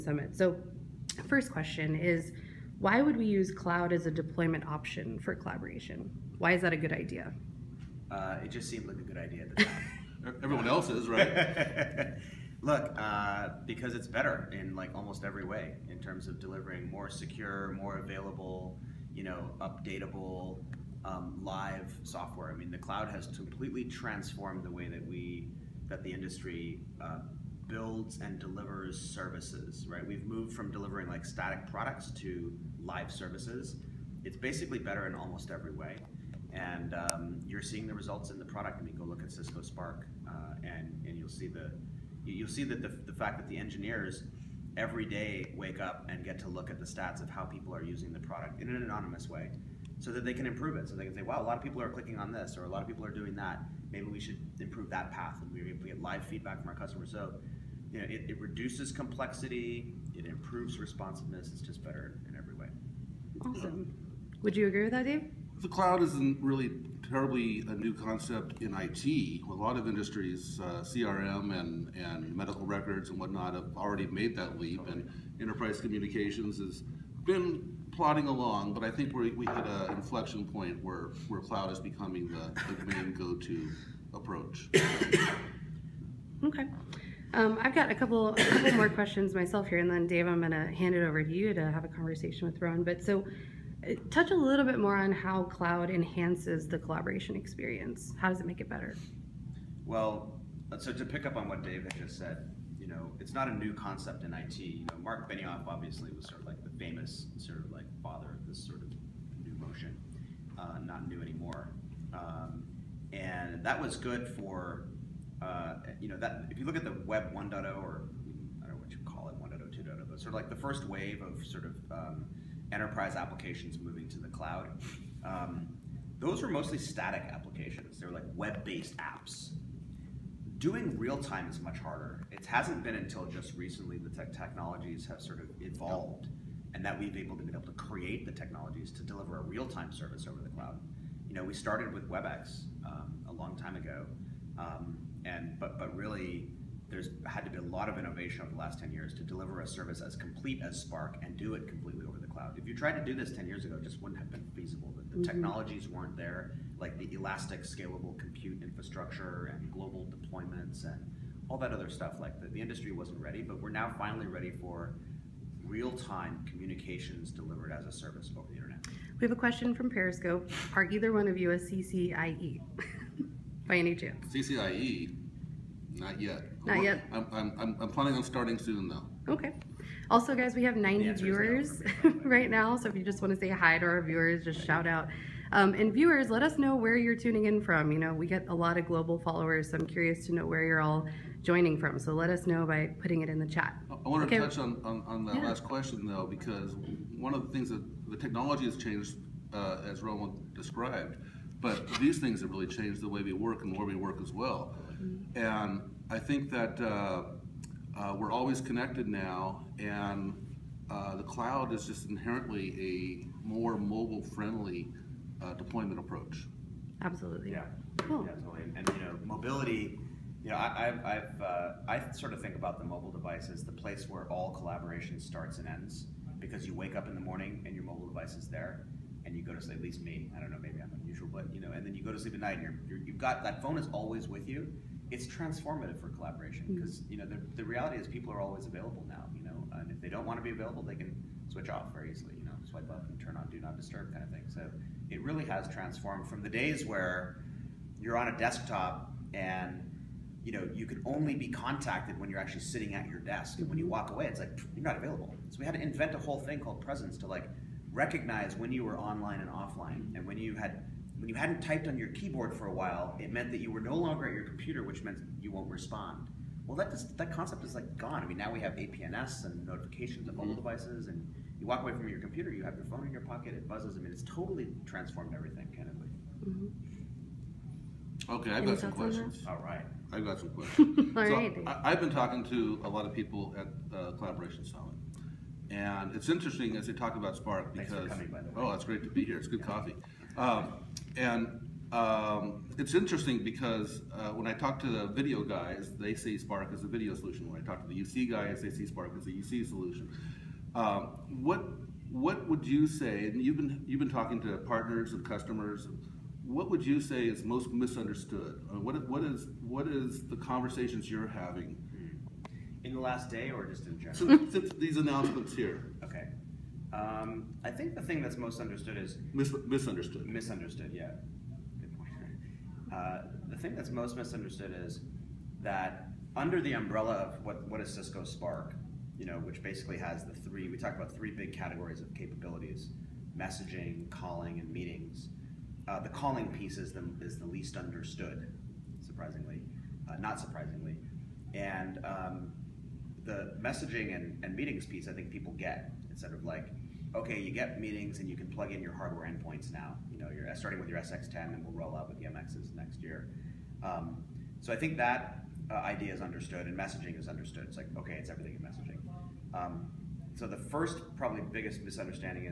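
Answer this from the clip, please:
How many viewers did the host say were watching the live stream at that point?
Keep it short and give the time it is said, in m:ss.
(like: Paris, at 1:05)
90, at 3:00.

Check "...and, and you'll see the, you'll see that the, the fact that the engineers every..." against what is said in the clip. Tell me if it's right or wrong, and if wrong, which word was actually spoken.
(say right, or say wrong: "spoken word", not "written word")
right.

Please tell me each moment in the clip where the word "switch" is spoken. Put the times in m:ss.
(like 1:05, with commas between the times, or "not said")
4:01.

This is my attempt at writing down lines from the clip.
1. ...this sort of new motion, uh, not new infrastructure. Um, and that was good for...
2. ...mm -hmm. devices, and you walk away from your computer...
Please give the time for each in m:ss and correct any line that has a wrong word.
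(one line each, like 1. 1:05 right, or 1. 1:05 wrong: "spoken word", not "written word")
1. 1:48 wrong: "anymore", not "infrastructure"
2. 4:30 right.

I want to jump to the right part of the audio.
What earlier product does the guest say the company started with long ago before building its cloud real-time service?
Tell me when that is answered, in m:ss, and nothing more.
2:22.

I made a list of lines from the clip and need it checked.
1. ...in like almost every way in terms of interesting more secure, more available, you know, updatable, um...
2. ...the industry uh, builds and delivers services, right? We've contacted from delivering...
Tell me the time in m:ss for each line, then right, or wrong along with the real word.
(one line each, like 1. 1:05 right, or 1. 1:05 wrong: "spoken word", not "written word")
1. 0:14 wrong: "delivering", not "interesting"
2. 0:26 wrong: "moved", not "contacted".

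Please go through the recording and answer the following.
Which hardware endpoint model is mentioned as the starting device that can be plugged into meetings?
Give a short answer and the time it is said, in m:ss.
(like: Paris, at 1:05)
SX10, at 5:50.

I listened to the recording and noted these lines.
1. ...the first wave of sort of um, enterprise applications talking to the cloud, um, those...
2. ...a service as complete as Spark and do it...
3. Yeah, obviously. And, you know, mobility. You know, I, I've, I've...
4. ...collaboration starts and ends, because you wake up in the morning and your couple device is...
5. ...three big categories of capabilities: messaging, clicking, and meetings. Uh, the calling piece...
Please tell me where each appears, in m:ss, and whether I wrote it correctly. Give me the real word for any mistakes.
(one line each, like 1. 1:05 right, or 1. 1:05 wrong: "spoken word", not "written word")
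1. 2:00 wrong: "moving", not "talking"
2. 2:29 right
3. 3:38 wrong: "totally", not "obviously"
4. 3:44 wrong: "mobile", not "couple"
5. 5:31 wrong: "calling", not "clicking".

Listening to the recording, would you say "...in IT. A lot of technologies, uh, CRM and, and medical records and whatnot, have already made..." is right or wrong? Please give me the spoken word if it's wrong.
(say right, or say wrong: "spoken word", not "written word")
wrong: "industries", not "technologies".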